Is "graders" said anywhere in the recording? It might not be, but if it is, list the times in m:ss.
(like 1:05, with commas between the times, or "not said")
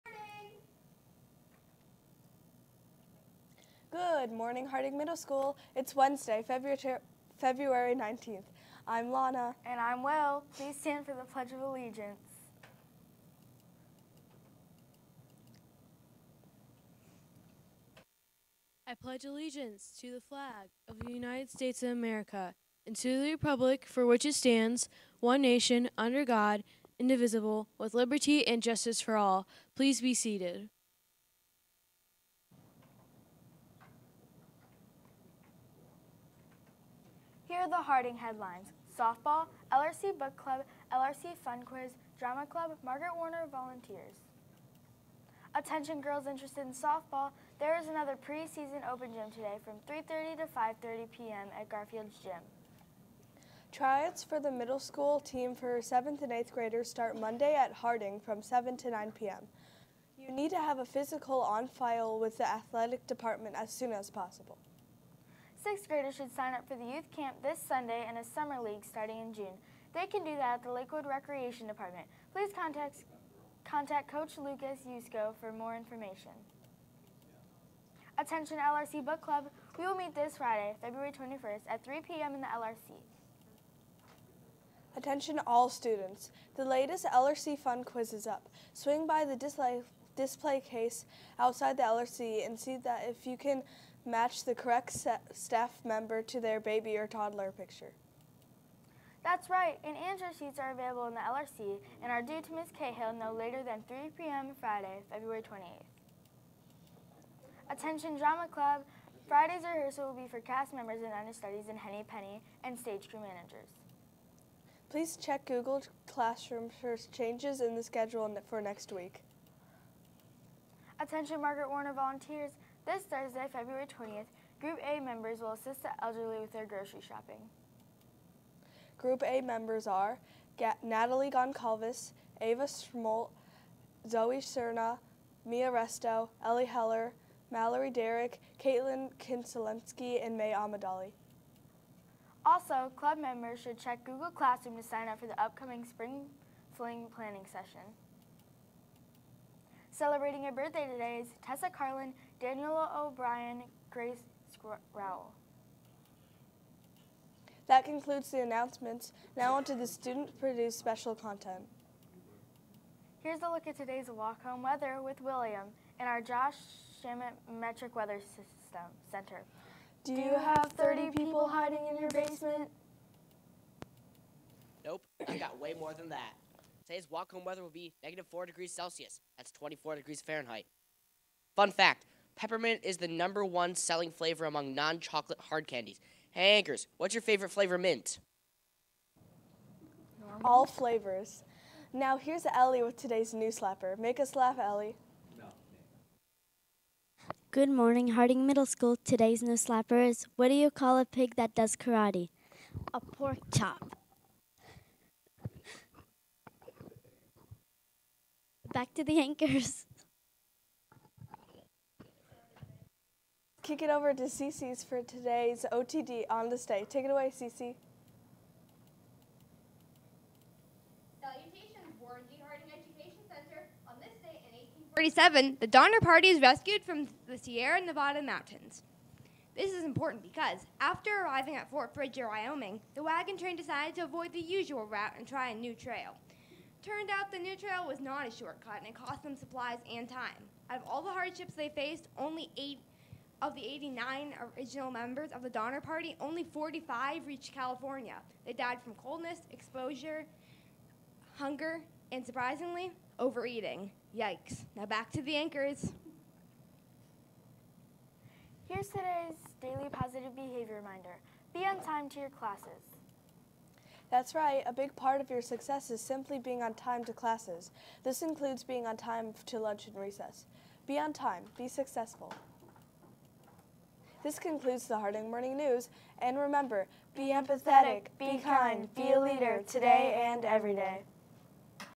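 0:56, 1:05.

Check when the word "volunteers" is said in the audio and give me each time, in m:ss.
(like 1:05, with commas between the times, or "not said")
0:43, 2:01.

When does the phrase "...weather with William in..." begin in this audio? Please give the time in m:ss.
2:44.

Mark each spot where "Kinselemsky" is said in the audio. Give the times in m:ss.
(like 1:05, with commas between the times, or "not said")
2:19.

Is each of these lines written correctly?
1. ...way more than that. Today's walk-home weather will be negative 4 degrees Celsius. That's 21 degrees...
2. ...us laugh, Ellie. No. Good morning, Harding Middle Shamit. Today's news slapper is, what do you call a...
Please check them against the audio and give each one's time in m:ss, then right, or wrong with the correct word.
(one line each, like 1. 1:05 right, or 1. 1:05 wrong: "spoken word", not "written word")
1. 2:55 wrong: "24", not "21"
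2. 3:14 wrong: "School", not "Shamit".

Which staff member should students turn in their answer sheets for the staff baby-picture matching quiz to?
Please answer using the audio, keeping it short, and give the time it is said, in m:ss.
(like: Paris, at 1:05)
Ms. Cahill, at 1:42.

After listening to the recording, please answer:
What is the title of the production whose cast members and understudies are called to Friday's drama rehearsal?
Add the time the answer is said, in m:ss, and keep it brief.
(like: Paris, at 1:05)
Henny Penny, at 1:51.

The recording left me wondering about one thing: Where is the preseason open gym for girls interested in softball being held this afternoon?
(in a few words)
Garfield's Gym.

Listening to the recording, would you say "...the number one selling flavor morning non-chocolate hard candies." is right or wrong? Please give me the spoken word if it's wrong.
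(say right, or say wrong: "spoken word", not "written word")
wrong: "among", not "morning".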